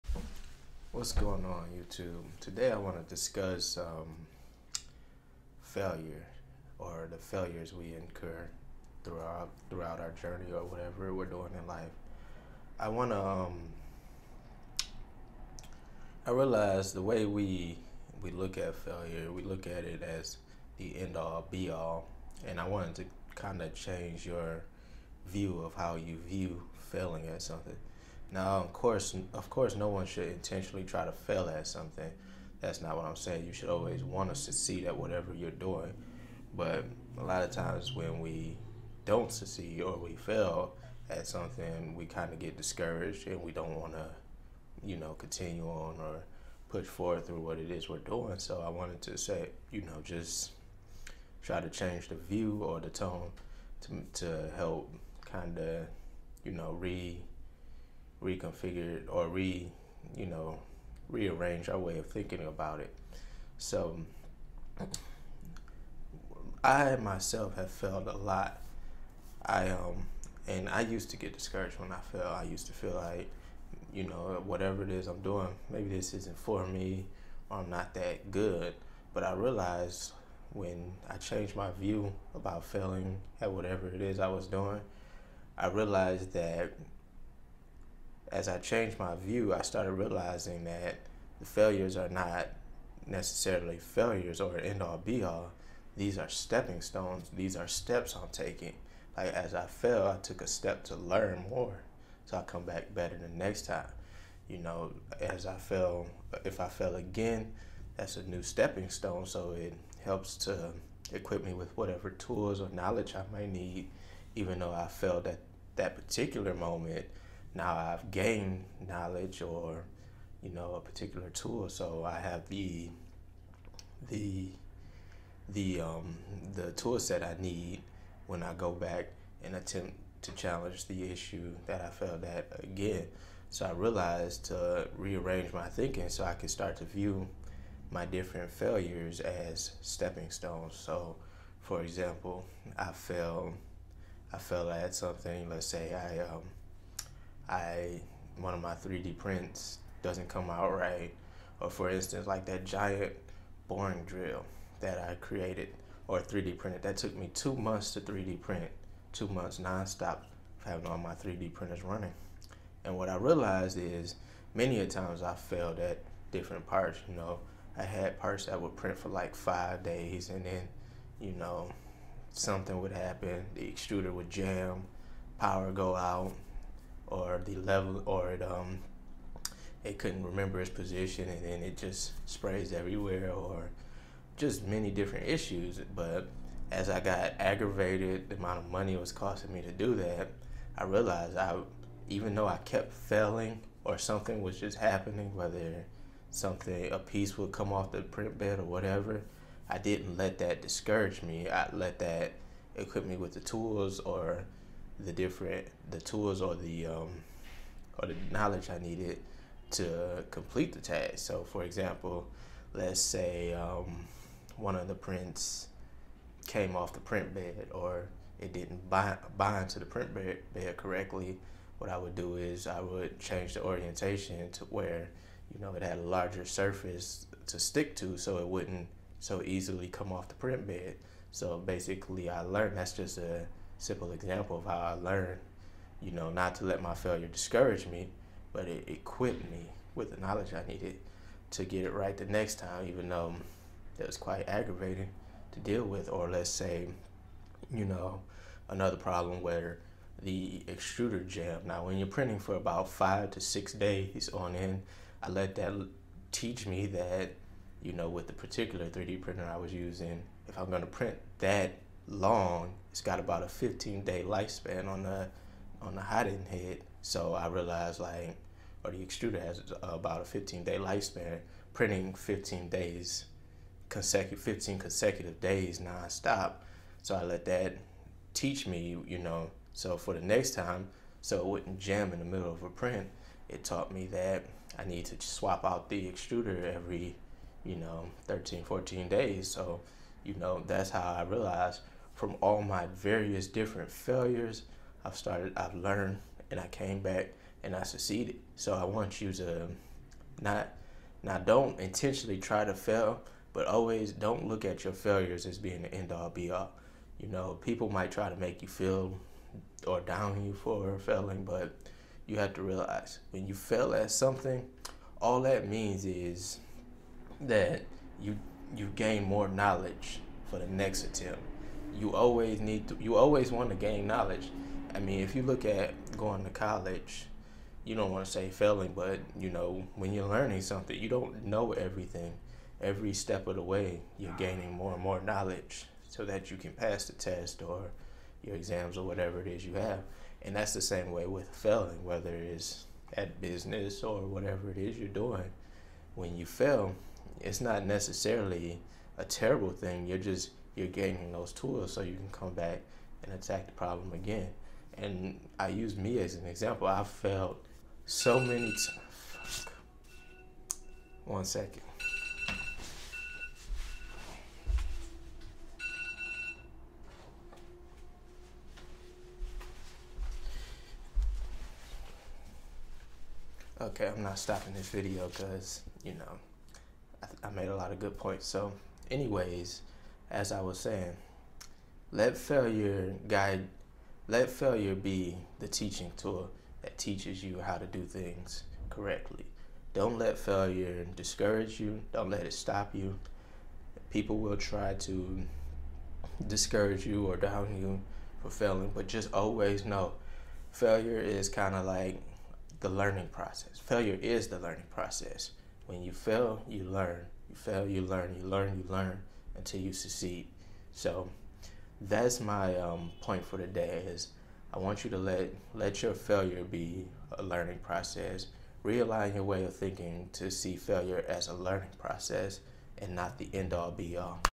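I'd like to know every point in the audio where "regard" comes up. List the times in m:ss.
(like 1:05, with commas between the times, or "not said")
not said.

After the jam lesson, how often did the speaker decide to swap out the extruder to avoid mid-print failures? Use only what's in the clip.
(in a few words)
every 13 to 14 days.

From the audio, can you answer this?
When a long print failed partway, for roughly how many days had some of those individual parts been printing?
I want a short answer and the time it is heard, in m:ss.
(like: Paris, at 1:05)
5 days, at 2:49.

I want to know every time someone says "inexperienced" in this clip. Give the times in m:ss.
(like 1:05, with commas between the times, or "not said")
not said.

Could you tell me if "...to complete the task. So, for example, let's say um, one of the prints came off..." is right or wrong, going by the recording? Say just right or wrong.
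right.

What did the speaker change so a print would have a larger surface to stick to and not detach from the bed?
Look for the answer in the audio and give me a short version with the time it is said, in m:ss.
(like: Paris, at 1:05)
orientation, at 3:43.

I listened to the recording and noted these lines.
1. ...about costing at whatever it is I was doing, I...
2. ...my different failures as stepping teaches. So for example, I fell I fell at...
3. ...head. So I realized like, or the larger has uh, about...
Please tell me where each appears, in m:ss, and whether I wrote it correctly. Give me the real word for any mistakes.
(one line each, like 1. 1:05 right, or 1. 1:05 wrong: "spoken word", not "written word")
1. 1:22 wrong: "failing", not "costing"
2. 2:17 wrong: "stones", not "teaches"
3. 4:26 wrong: "extruder", not "larger".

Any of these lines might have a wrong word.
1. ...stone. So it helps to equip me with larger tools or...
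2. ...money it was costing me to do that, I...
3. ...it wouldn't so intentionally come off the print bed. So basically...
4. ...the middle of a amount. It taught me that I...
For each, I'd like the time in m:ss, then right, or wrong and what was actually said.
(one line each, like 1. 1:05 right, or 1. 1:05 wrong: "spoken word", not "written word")
1. 1:48 wrong: "whatever", not "larger"
2. 3:08 right
3. 3:48 wrong: "easily", not "intentionally"
4. 4:42 wrong: "print", not "amount".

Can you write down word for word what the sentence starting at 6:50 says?
So that's my um, point for today is I want you to let let your failure be a learning process.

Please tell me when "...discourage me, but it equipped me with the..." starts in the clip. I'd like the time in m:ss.
3:57.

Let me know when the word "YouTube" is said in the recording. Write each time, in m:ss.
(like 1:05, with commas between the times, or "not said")
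0:01.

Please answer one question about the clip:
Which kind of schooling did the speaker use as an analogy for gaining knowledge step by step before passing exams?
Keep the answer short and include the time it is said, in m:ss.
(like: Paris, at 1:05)
college, at 5:26.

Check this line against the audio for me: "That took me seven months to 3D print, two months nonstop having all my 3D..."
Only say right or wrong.
wrong.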